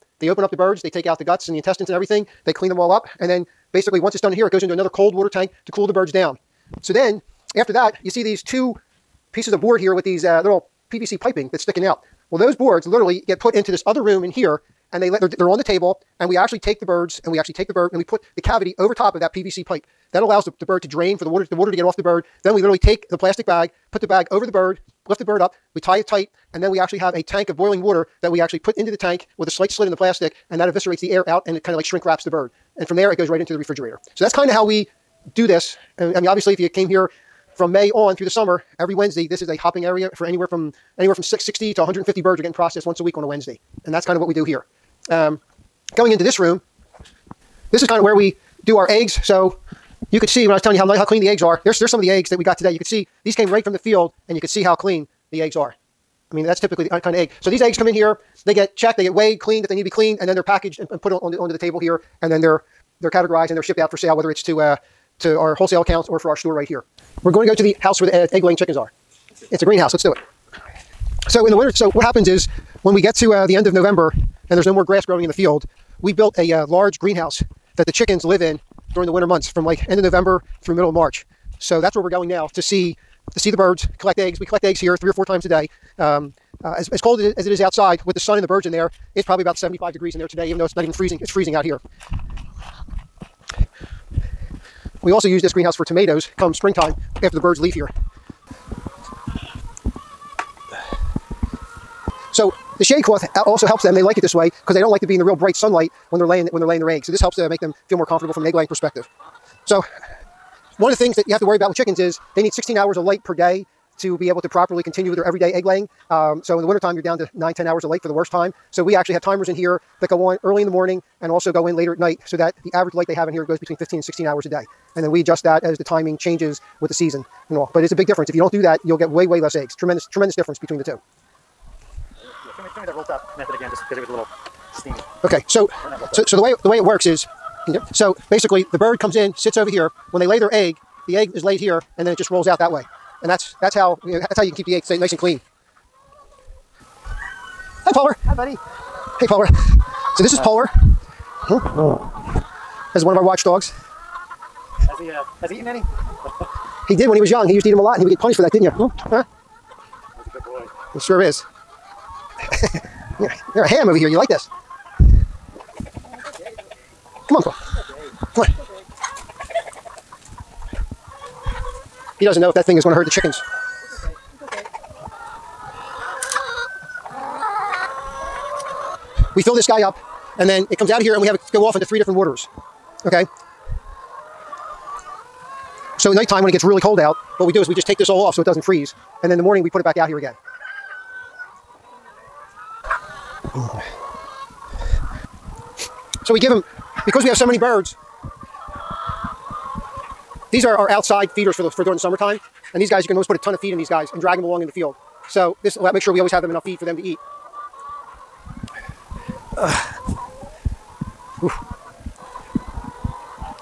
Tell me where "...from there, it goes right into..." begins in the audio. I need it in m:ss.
0:32.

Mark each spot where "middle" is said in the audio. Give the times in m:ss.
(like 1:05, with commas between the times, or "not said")
1:20.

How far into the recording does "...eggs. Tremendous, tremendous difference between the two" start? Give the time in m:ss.
2:09.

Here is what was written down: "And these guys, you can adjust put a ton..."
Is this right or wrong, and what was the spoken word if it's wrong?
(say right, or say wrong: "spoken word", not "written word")
wrong: "almost", not "adjust".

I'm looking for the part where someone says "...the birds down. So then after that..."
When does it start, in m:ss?
0:05.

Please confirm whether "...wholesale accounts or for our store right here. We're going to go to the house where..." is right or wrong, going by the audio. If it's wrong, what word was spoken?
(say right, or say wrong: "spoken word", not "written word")
right.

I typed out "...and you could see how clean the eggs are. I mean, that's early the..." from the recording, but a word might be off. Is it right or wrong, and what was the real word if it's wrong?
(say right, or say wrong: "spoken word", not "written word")
wrong: "typically", not "early".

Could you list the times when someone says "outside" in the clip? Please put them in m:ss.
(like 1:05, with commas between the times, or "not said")
1:27, 3:20.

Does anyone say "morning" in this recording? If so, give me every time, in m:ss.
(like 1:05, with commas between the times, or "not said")
2:00, 3:09.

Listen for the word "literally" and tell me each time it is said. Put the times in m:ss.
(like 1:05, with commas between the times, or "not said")
0:12, 0:22.